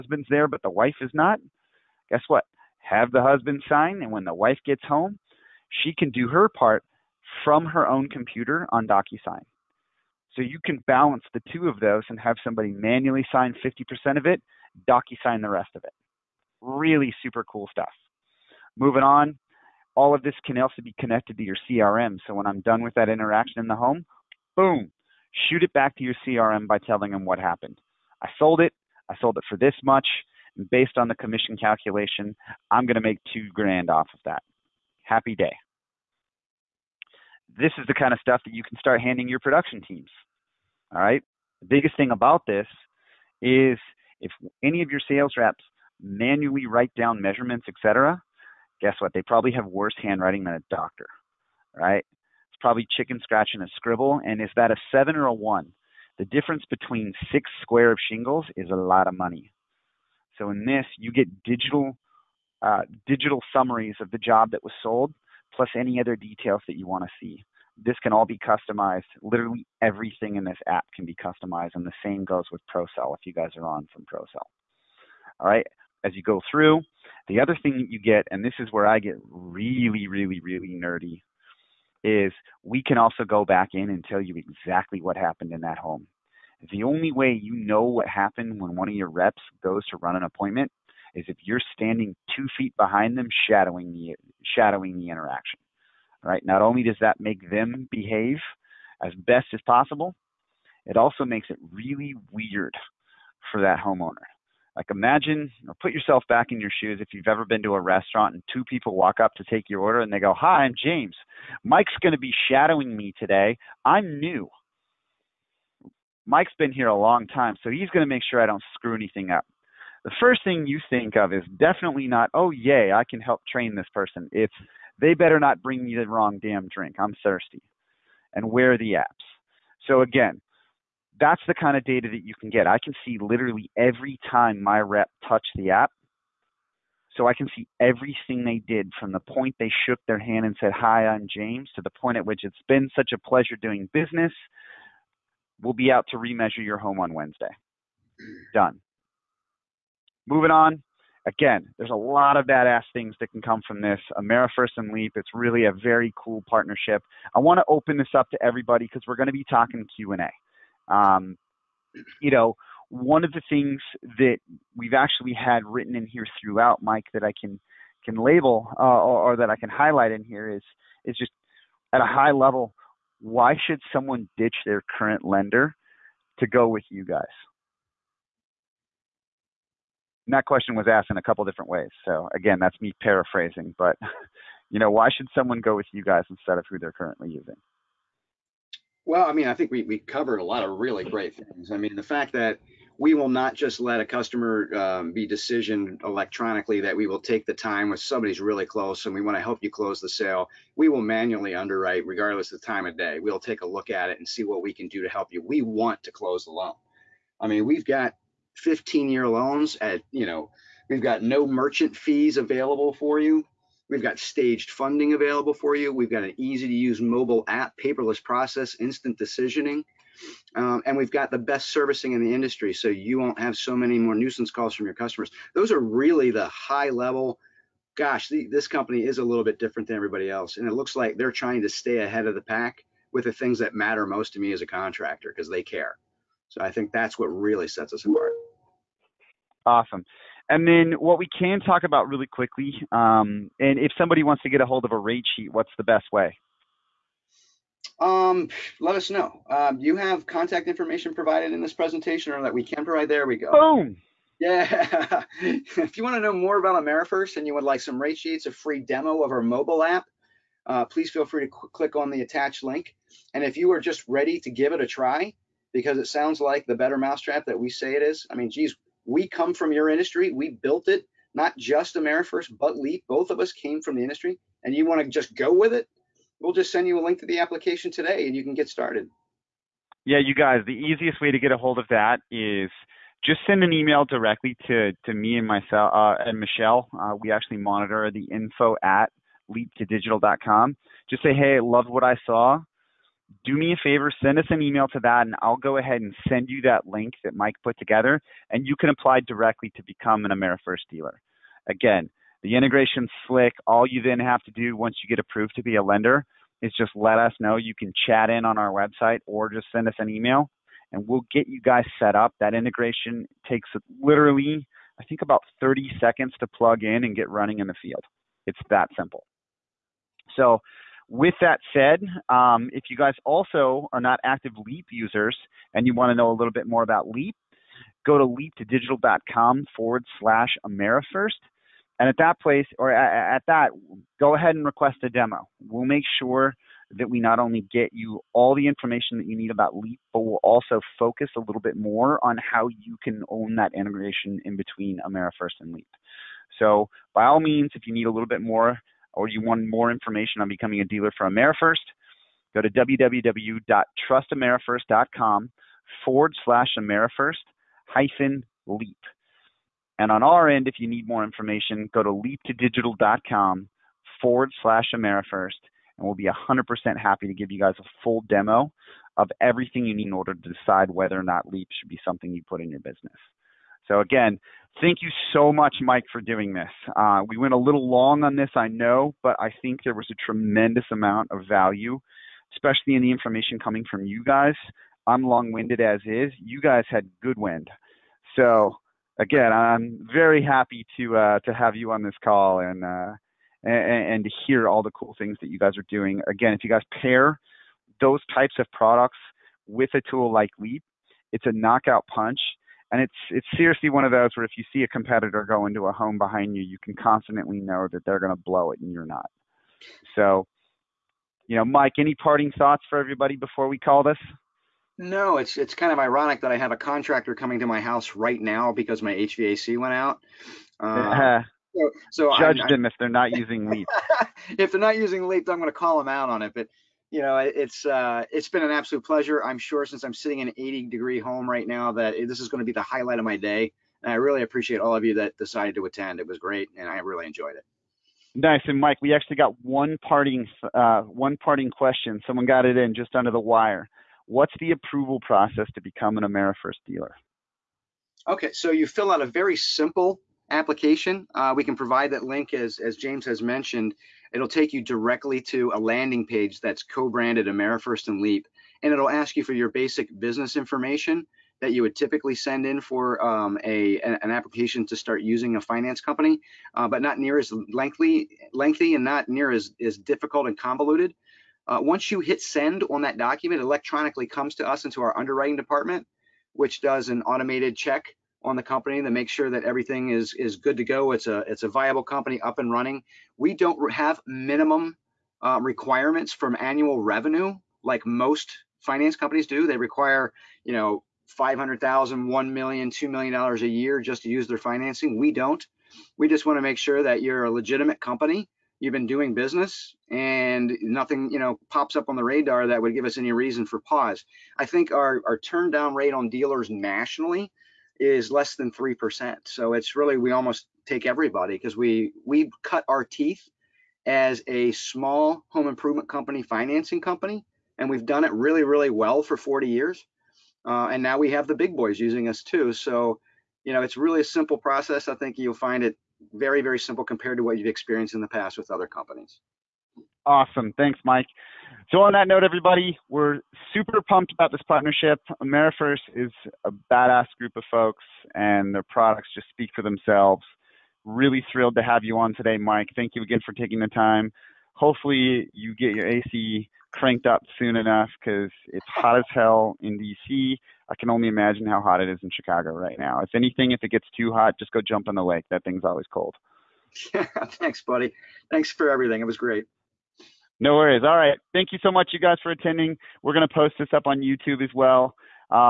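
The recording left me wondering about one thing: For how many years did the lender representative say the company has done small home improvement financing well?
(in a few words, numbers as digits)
40.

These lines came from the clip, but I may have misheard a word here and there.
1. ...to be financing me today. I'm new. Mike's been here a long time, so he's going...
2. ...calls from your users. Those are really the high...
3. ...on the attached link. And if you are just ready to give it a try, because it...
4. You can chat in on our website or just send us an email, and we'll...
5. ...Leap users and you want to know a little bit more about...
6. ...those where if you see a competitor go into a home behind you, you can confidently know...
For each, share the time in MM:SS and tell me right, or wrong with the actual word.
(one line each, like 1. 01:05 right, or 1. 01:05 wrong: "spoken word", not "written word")
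1. 01:52 wrong: "shadowing", not "financing"
2. 03:44 wrong: "customers", not "users"
3. 04:21 right
4. 05:07 right
5. 05:24 right
6. 06:44 right.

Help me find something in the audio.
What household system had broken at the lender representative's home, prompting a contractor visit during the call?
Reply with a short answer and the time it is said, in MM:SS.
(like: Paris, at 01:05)
HVAC, at 06:59.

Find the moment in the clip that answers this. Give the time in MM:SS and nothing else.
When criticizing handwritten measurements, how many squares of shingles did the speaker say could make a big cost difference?
00:57.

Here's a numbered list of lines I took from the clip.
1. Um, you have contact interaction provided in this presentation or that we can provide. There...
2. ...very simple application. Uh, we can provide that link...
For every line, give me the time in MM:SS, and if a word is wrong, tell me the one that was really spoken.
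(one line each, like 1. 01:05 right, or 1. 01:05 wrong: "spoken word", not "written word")
1. 04:09 wrong: "information", not "interaction"
2. 07:29 right.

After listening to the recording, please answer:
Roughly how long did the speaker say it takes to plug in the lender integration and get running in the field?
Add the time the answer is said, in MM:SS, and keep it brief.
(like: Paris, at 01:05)
30 seconds, at 05:15.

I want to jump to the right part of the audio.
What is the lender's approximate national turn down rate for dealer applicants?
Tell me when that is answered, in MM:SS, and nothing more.
08:28.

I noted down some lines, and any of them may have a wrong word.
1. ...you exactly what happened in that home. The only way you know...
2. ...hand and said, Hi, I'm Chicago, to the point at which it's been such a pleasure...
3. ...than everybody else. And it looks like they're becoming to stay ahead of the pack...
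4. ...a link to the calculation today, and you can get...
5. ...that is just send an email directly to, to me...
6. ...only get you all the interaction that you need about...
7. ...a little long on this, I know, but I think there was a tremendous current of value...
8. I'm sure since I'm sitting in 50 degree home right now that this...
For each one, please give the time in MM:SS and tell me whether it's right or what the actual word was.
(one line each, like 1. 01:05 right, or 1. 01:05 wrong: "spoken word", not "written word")
1. 01:24 right
2. 02:20 wrong: "James", not "Chicago"
3. 03:49 wrong: "trying", not "becoming"
4. 04:36 wrong: "application", not "calculation"
5. 04:41 right
6. 05:37 wrong: "information", not "interaction"
7. 06:17 wrong: "amount", not "current"
8. 07:09 wrong: "80", not "50".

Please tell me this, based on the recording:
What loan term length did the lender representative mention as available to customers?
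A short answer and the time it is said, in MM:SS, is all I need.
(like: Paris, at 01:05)
15 year, at 03:28.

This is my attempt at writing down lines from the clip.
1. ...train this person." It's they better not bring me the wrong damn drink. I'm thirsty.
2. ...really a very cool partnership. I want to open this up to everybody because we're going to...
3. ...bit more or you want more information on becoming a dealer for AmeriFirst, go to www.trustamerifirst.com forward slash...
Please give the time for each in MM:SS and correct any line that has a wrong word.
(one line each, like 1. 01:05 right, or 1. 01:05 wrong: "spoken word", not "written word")
1. 02:03 right
2. 02:35 right
3. 05:48 right.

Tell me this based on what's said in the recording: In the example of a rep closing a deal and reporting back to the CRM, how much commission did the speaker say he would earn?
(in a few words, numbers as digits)
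two grand.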